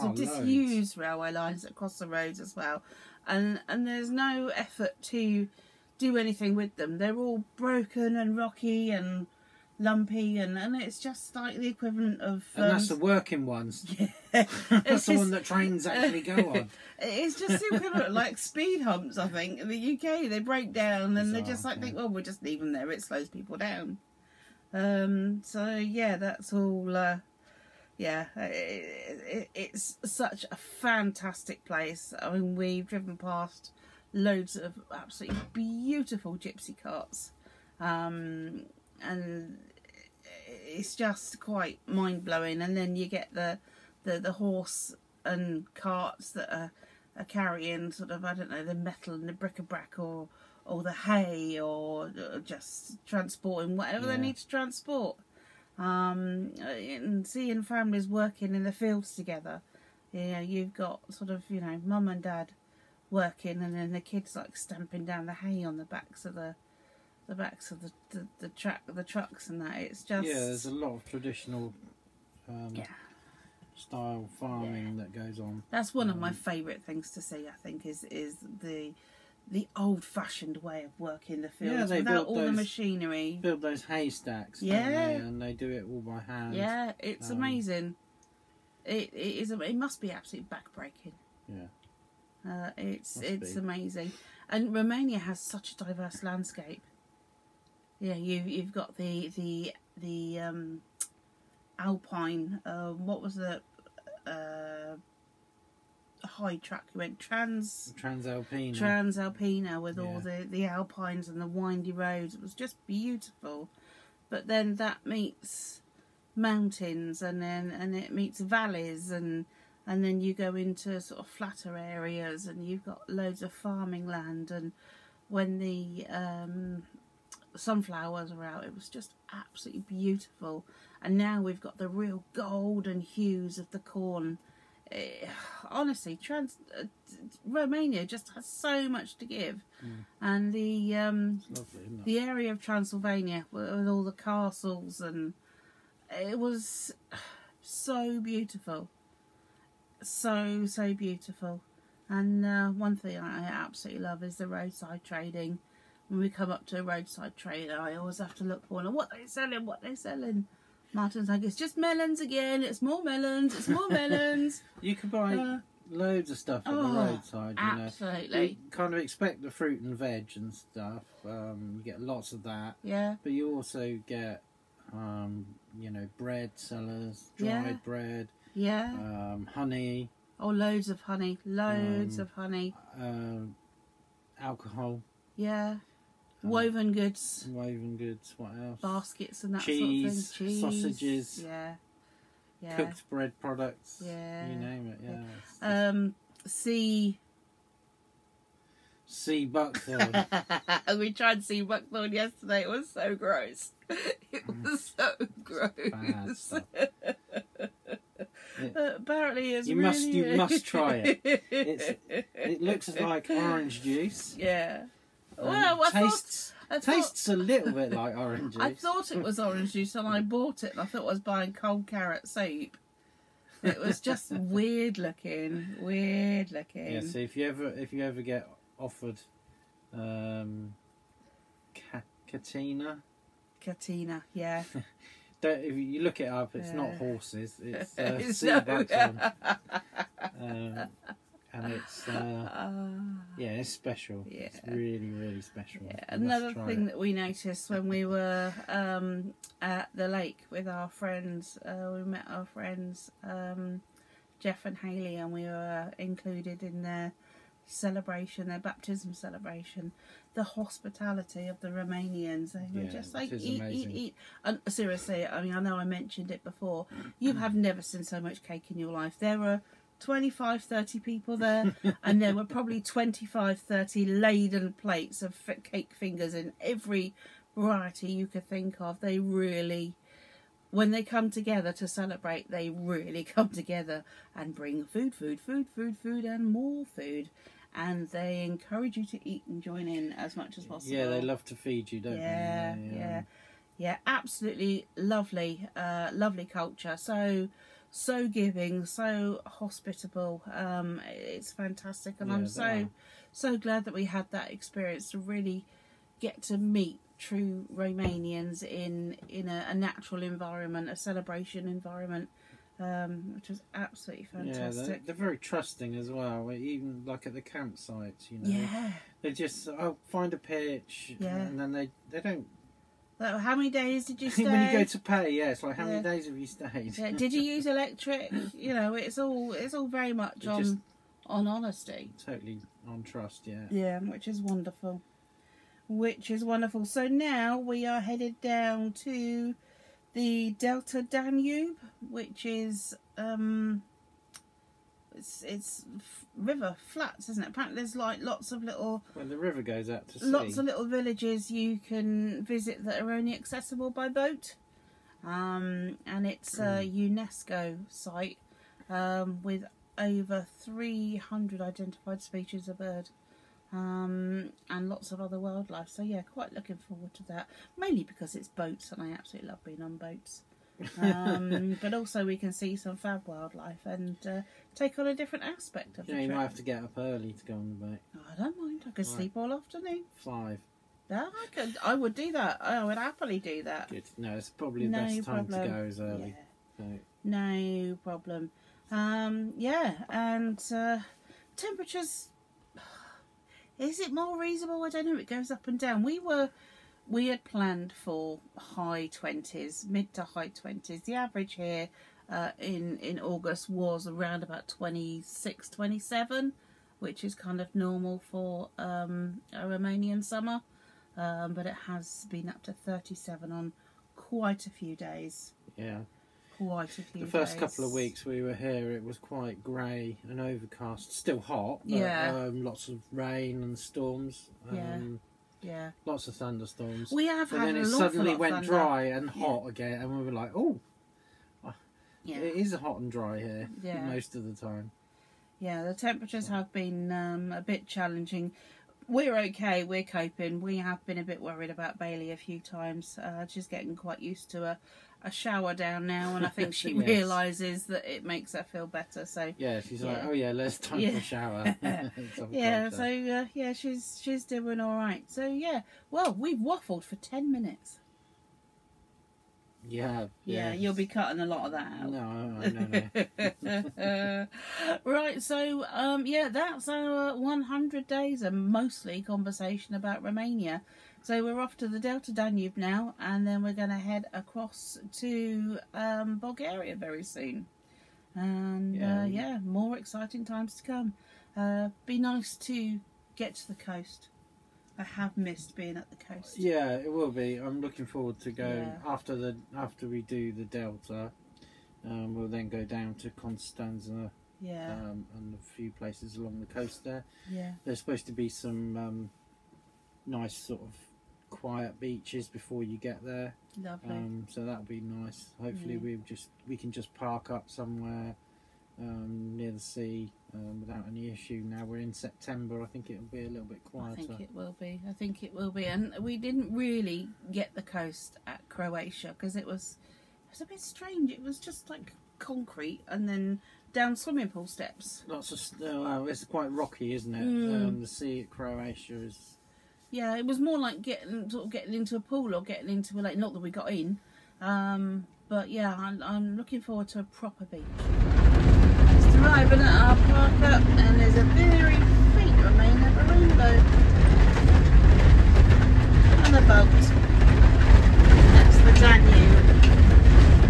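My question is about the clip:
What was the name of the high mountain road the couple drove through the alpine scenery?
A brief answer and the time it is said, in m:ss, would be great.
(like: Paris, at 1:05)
Transalpina, at 1:48.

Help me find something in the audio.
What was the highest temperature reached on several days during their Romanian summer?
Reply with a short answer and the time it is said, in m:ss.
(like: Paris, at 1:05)
37, at 6:52.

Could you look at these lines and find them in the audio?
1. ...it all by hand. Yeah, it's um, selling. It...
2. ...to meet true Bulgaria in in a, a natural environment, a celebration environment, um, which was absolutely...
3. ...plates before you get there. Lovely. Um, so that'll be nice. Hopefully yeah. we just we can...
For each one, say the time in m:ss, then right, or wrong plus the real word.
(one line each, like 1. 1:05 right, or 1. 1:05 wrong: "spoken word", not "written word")
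1. 1:25 wrong: "amazing", not "selling"
2. 5:06 wrong: "Romanians", not "Bulgaria"
3. 8:22 wrong: "beaches", not "plates".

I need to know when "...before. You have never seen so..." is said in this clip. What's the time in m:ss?
4:26.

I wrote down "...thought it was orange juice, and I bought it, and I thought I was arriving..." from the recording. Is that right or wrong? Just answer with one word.
wrong.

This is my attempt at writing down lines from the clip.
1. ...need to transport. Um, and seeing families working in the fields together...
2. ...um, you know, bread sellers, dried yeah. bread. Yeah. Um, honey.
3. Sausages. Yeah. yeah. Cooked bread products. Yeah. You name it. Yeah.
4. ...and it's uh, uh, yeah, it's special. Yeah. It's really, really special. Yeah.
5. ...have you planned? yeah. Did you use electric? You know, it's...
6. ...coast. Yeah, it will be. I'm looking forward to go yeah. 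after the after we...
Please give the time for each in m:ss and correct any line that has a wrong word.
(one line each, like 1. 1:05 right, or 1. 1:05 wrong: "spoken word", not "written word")
1. 0:54 right
2. 2:54 right
3. 3:10 right
4. 4:01 right
5. 5:26 wrong: "stayed", not "planned"
6. 8:06 right.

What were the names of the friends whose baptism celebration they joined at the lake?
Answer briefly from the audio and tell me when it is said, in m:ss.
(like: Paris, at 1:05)
Jeff and Haley, at 4:14.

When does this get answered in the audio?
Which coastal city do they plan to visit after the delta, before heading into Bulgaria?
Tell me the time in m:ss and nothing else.
8:13.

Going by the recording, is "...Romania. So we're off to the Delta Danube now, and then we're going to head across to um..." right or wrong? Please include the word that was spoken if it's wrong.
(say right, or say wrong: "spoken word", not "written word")
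right.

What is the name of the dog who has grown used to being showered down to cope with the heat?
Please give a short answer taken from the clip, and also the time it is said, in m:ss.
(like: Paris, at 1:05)
Bailey, at 7:22.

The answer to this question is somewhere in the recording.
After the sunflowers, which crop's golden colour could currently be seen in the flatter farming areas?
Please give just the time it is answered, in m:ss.
2:13.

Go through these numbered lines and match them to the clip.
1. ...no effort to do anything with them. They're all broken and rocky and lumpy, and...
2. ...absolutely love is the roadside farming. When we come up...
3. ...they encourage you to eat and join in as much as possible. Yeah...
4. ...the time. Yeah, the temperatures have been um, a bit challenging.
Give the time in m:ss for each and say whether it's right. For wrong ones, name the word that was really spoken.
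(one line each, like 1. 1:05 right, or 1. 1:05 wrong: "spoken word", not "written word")
1. 0:04 right
2. 2:33 wrong: "trading", not "farming"
3. 4:48 right
4. 7:14 right.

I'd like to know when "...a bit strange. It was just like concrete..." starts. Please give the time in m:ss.
8:40.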